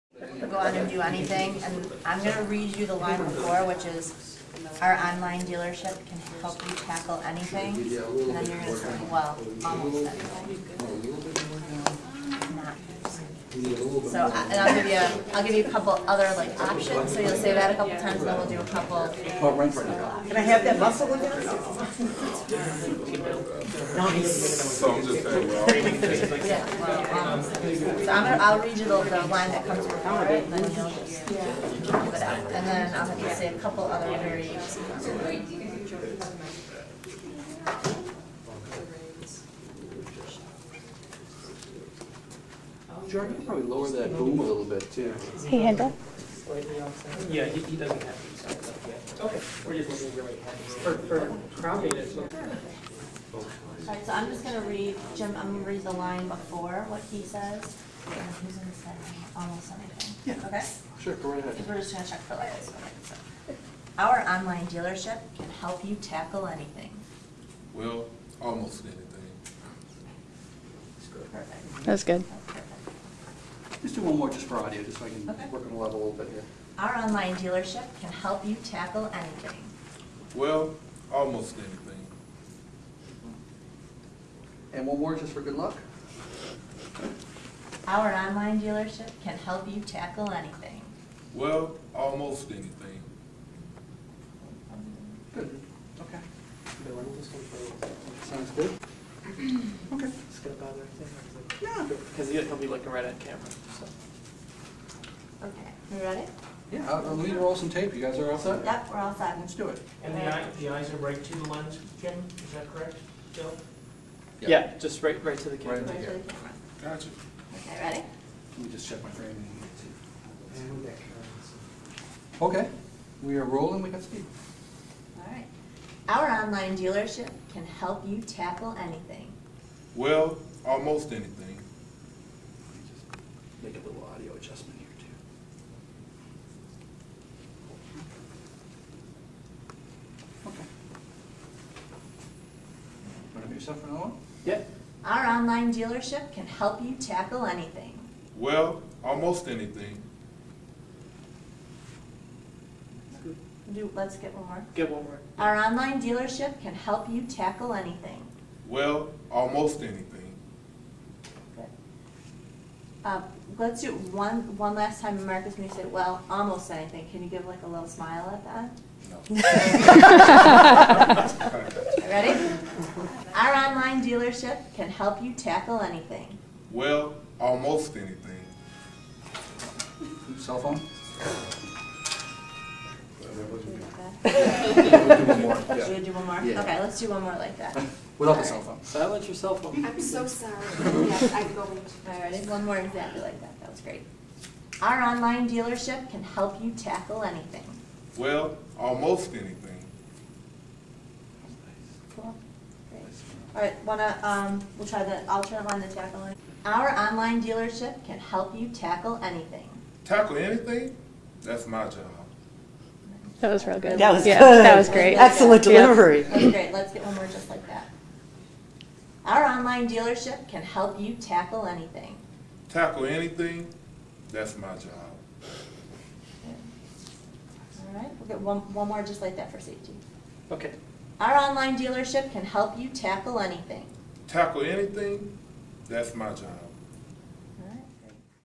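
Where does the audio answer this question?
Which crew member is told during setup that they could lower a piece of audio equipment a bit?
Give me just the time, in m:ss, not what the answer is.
0:43.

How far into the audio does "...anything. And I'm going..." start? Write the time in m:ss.
0:01.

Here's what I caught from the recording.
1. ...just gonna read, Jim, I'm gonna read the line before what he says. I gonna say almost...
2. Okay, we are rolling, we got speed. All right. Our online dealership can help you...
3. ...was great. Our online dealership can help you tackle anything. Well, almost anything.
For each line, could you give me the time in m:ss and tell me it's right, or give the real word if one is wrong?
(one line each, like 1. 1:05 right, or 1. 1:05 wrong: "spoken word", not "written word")
1. 0:54 right
2. 2:02 right
3. 3:13 right.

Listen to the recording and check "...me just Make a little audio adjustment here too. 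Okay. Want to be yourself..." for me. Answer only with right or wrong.
right.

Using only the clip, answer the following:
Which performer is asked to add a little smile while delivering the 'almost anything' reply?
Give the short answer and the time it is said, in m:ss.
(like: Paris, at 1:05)
Marcus, at 2:45.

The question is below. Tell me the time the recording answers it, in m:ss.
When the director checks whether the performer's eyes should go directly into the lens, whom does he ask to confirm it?
1:53.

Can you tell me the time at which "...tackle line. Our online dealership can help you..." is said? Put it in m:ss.
3:25.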